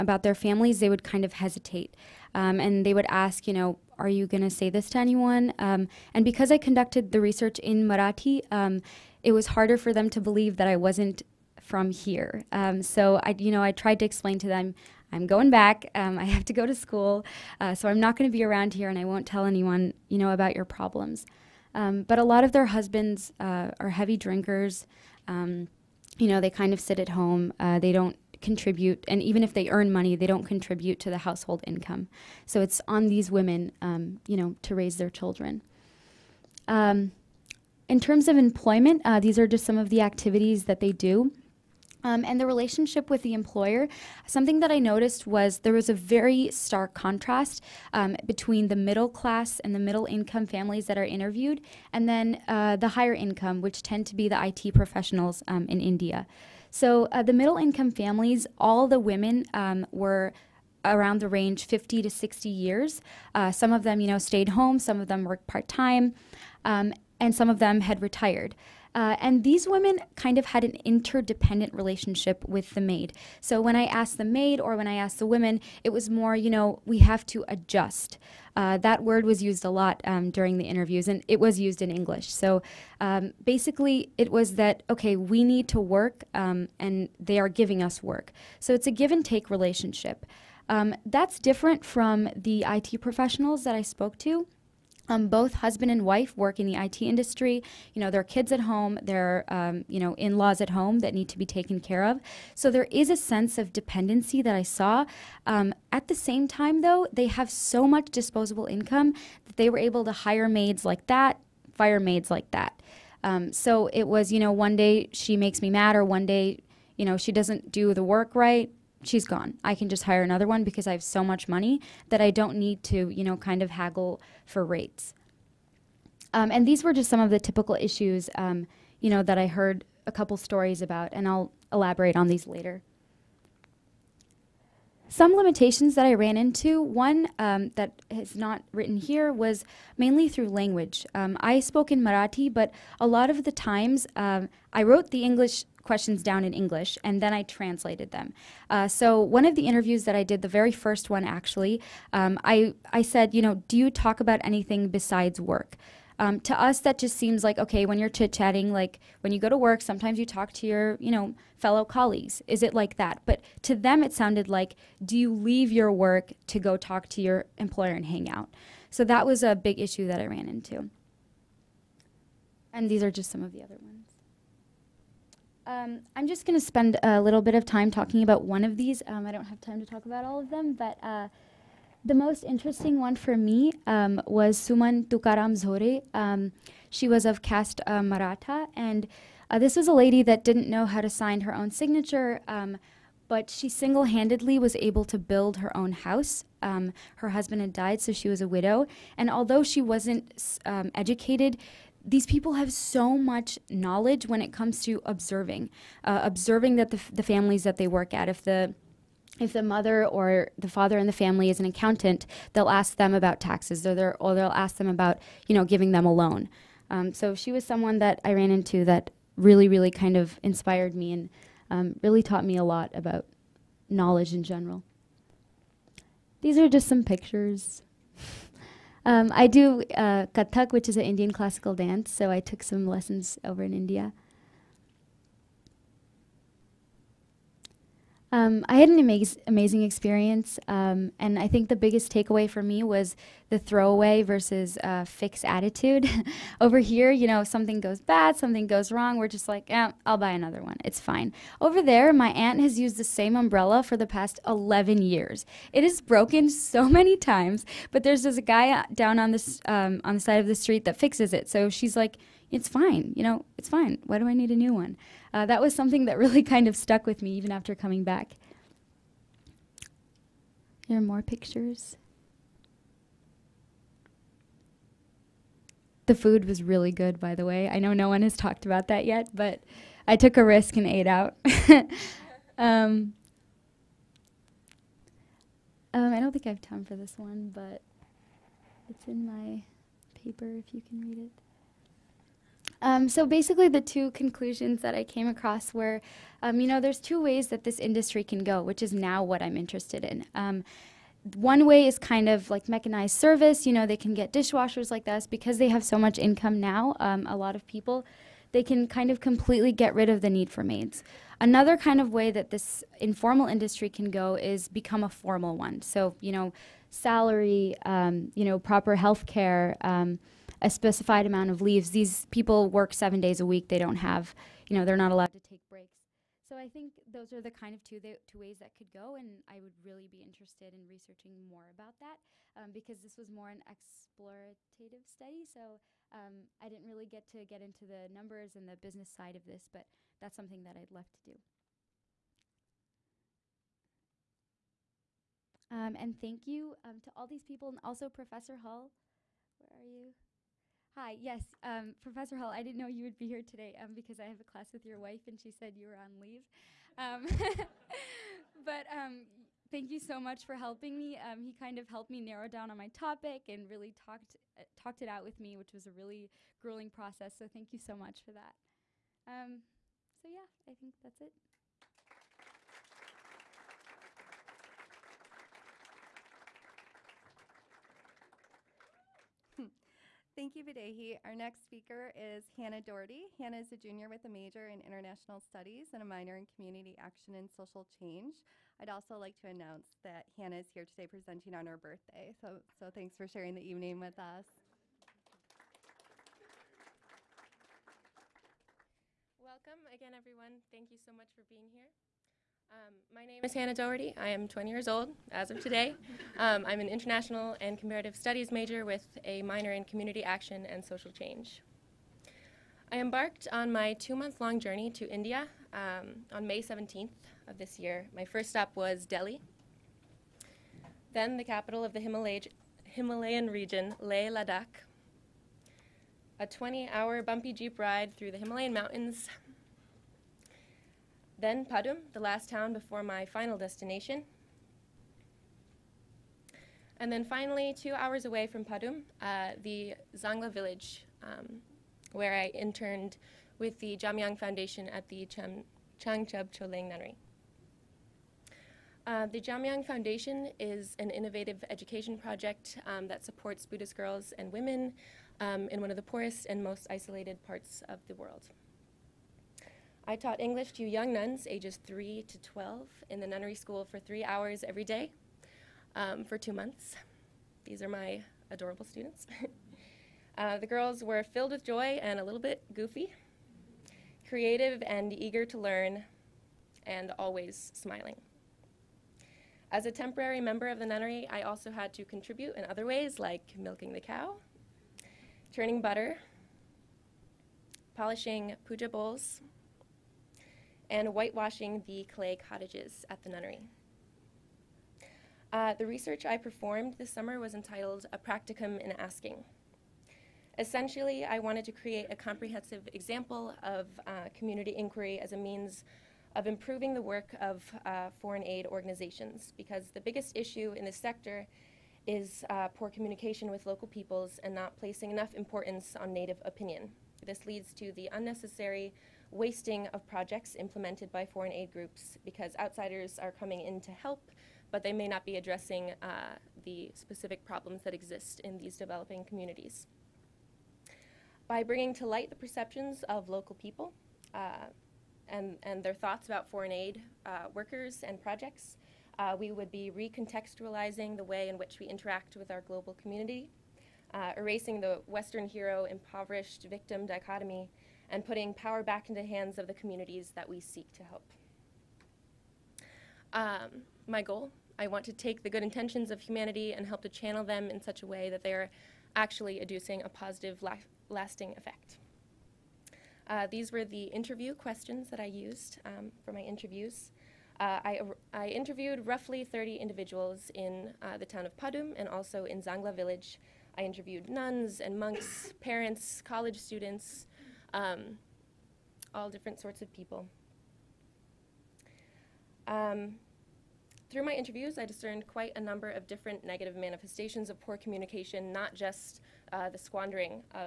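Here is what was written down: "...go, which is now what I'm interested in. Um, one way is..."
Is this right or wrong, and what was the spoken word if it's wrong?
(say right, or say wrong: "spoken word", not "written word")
right.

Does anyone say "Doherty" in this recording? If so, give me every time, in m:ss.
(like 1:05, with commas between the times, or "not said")
6:22, 6:43.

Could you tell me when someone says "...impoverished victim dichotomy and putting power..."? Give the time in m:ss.
9:05.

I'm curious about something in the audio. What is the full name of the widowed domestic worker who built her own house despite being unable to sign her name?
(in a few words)
Suman Tukaram Zore.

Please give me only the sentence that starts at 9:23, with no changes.
Uh, these were the interview questions that I used um, for my interviews.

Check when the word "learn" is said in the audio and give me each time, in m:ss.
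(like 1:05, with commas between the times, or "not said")
7:55.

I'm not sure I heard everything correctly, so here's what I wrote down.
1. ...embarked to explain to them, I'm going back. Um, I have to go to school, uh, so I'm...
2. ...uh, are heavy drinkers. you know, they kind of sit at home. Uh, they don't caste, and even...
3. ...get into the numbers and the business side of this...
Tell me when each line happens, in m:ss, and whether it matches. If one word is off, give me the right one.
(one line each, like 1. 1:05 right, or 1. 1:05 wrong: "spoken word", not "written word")
1. 0:13 wrong: "tried", not "embarked"
2. 0:23 wrong: "contribute", not "caste"
3. 5:37 right.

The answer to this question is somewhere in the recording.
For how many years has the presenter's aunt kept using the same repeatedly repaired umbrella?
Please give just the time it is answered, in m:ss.
4:14.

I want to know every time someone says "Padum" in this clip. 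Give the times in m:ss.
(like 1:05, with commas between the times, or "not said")
7:11, 7:18, 9:31.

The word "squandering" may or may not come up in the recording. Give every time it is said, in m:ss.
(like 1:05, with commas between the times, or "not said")
9:49.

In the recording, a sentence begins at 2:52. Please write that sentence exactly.
And these are just some of the other ones.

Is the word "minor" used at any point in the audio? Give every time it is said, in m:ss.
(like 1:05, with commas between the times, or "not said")
6:26, 6:49.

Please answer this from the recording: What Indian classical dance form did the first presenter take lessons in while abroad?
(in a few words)
Kathak.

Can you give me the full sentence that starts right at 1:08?
Uh, and these women kind of had an interdependent relationship with the maid.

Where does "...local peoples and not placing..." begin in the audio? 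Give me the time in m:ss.
8:33.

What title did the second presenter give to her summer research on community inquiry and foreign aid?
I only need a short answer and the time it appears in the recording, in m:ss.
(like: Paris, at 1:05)
A Practicum in Asking, at 8:18.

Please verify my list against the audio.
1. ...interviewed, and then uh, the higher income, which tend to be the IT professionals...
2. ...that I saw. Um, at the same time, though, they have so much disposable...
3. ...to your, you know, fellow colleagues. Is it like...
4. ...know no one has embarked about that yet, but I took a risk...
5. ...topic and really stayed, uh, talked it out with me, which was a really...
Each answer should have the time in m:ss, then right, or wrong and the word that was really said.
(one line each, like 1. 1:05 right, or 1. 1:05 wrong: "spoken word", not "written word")
1. 0:51 right
2. 1:44 right
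3. 2:40 right
4. 4:37 wrong: "talked", not "embarked"
5. 6:02 wrong: "talked", not "stayed".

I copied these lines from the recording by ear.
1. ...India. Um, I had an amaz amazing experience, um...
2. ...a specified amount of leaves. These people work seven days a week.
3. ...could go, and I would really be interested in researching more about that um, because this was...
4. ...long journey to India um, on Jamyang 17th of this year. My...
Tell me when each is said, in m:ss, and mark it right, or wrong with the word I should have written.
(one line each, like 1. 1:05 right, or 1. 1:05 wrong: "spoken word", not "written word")
1. 3:53 right
2. 5:20 right
3. 5:28 right
4. 6:54 wrong: "May", not "Jamyang".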